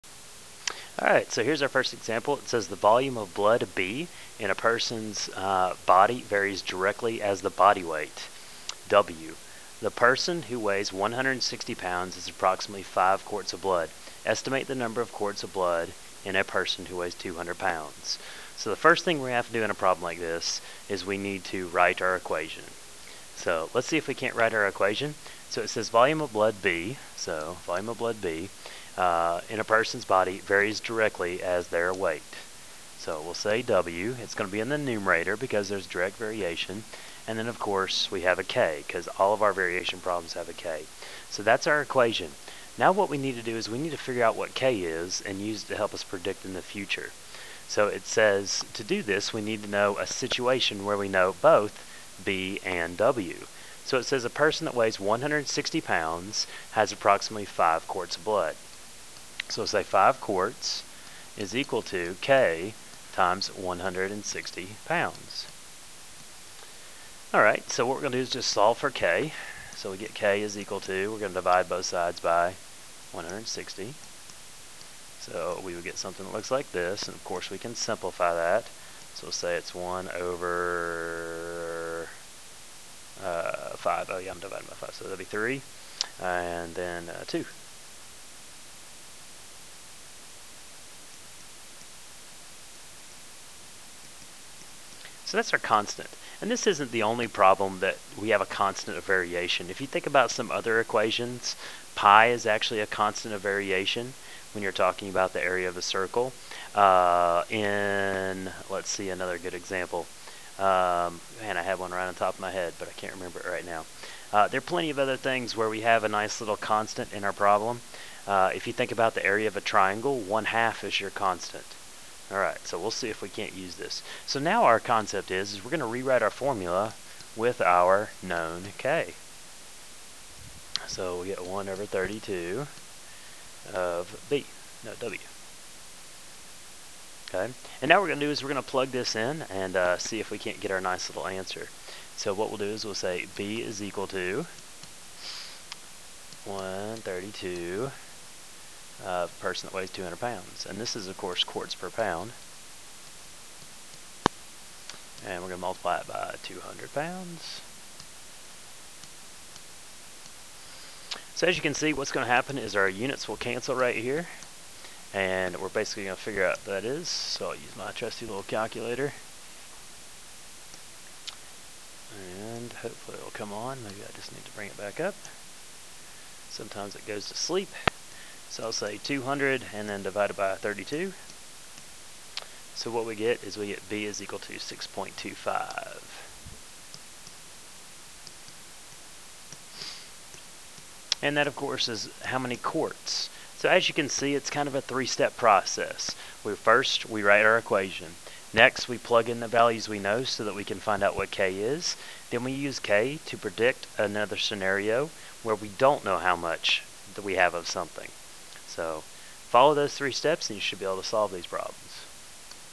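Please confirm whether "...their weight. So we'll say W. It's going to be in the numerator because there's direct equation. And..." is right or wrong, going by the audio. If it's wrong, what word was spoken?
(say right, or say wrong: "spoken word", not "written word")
wrong: "variation", not "equation".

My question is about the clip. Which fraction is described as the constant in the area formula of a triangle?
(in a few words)
one half.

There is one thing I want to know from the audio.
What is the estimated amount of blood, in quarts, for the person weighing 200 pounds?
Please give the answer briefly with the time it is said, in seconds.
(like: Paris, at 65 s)
6.25, at 184 s.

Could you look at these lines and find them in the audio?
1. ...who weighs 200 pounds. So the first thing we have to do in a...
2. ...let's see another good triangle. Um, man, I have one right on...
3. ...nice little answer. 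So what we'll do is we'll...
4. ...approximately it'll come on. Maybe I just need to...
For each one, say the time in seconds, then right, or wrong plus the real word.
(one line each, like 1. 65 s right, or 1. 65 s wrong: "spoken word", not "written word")
1. 16 s right
2. 108 s wrong: "example", not "triangle"
3. 140 s right
4. 172 s wrong: "hopefully", not "approximately".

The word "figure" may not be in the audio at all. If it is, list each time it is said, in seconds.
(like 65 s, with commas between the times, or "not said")
43 s, 166 s.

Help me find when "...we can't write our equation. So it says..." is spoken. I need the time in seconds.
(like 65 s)
24 s.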